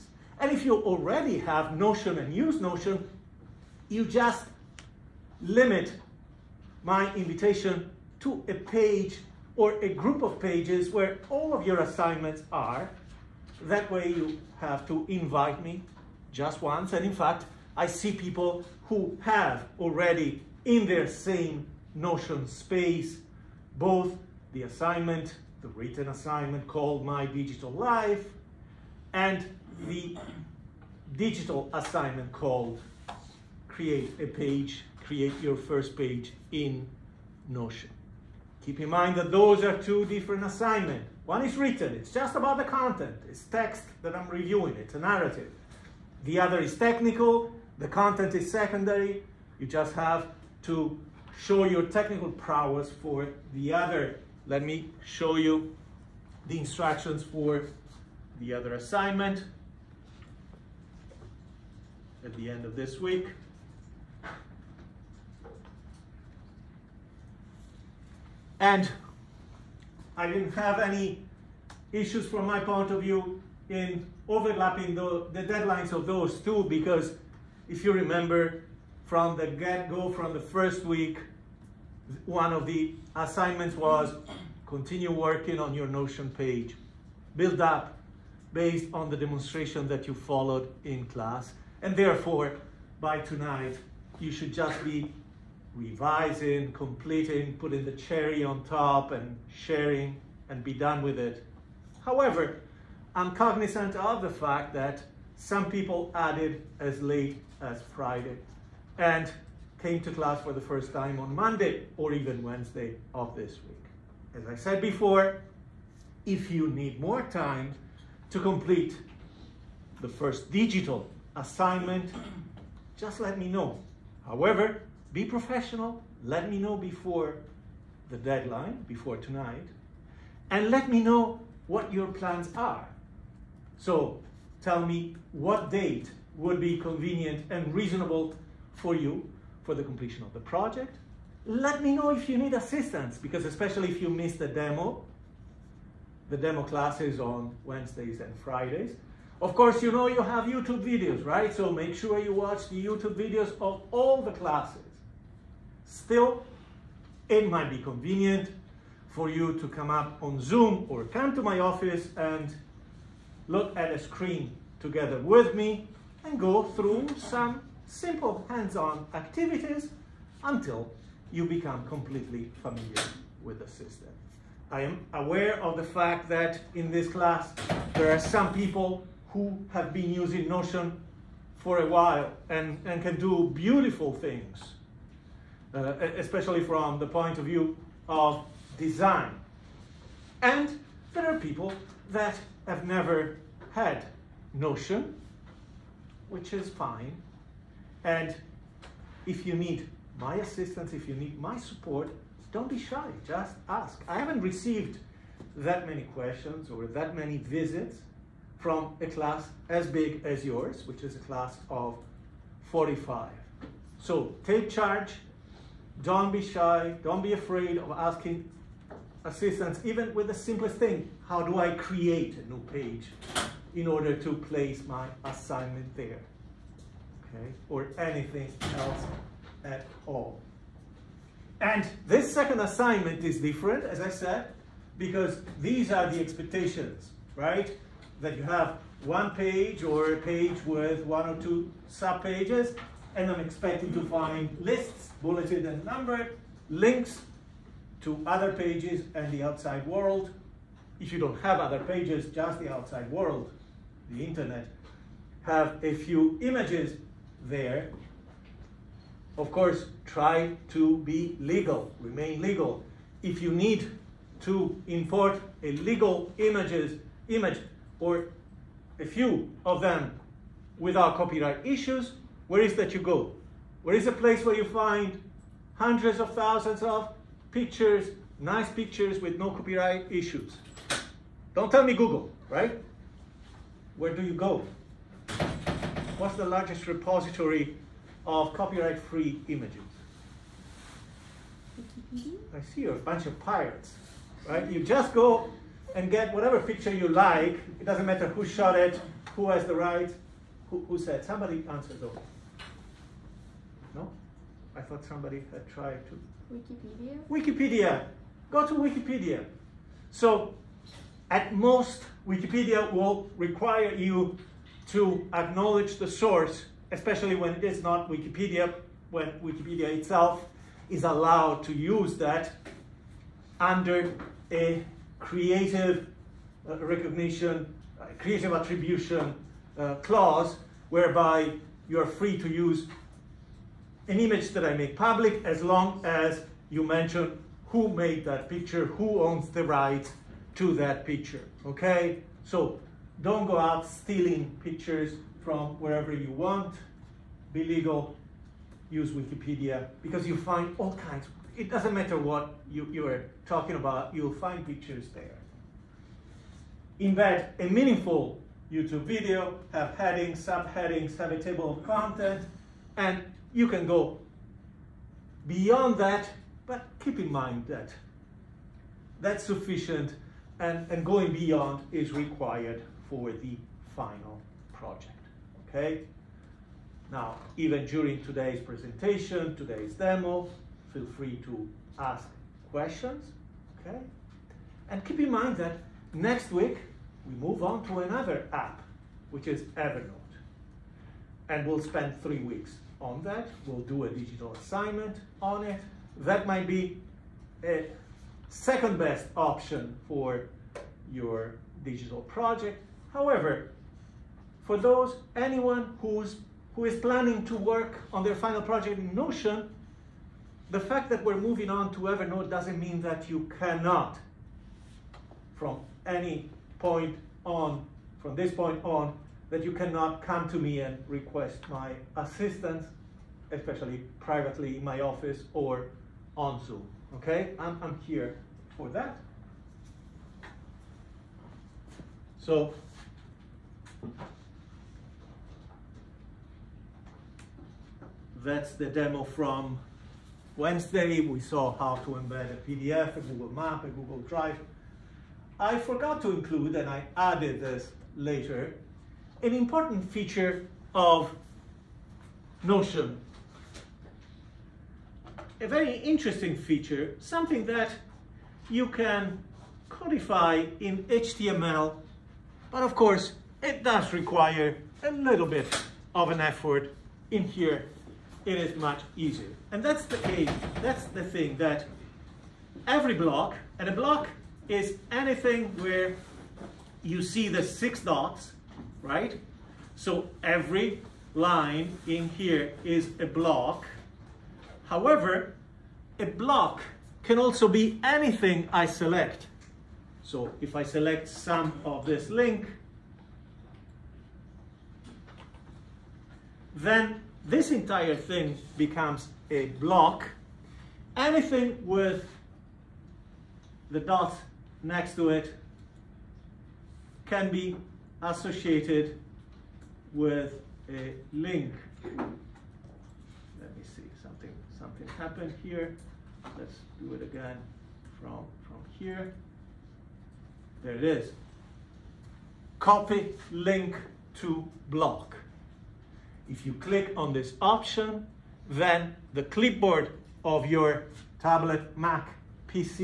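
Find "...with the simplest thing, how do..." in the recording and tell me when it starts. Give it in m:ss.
3:40.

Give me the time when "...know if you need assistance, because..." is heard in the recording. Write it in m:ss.
2:21.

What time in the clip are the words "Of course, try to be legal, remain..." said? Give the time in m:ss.
4:19.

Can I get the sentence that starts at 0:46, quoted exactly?
The other is technical, the content is secondary, you just have to show your technical prowess for the other.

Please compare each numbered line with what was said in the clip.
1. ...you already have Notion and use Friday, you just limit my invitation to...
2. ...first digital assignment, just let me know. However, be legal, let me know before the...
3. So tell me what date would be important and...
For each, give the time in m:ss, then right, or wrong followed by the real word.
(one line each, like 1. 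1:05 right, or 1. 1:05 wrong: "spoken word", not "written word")
1. 0:00 wrong: "Notion", not "Friday"
2. 2:00 wrong: "professional", not "legal"
3. 2:13 wrong: "convenient", not "important".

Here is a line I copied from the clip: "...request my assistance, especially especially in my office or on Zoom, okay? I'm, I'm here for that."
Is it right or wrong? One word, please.
wrong.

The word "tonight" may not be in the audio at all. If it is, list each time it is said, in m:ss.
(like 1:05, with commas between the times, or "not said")
1:33, 2:09.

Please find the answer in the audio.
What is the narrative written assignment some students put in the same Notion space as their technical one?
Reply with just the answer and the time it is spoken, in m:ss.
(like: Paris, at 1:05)
My Digital Life, at 0:27.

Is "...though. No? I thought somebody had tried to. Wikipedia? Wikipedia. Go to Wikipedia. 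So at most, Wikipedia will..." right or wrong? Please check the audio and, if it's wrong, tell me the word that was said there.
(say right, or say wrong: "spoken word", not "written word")
right.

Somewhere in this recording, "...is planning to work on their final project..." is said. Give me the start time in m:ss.
6:46.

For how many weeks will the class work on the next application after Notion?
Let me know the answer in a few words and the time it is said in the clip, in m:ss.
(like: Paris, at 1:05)
3, at 6:32.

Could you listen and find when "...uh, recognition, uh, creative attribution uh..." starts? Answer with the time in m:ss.
5:26.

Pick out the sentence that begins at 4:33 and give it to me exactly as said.
Where is a place where you find hundreds of thousands of pictures, nice pictures with no copyright issues?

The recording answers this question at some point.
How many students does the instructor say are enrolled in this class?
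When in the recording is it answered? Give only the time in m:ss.
3:32.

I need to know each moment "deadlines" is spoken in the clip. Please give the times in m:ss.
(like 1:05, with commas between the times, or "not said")
1:15, 2:08.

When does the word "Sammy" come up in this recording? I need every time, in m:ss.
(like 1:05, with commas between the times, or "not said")
not said.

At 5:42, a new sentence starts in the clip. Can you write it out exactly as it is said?
So don't go out stealing pictures from wherever you want.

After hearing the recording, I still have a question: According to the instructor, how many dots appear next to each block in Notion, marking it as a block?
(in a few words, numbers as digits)
6.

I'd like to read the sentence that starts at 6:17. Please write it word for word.
Now, even during today's presentation, today's demo, feel free to ask questions, okay?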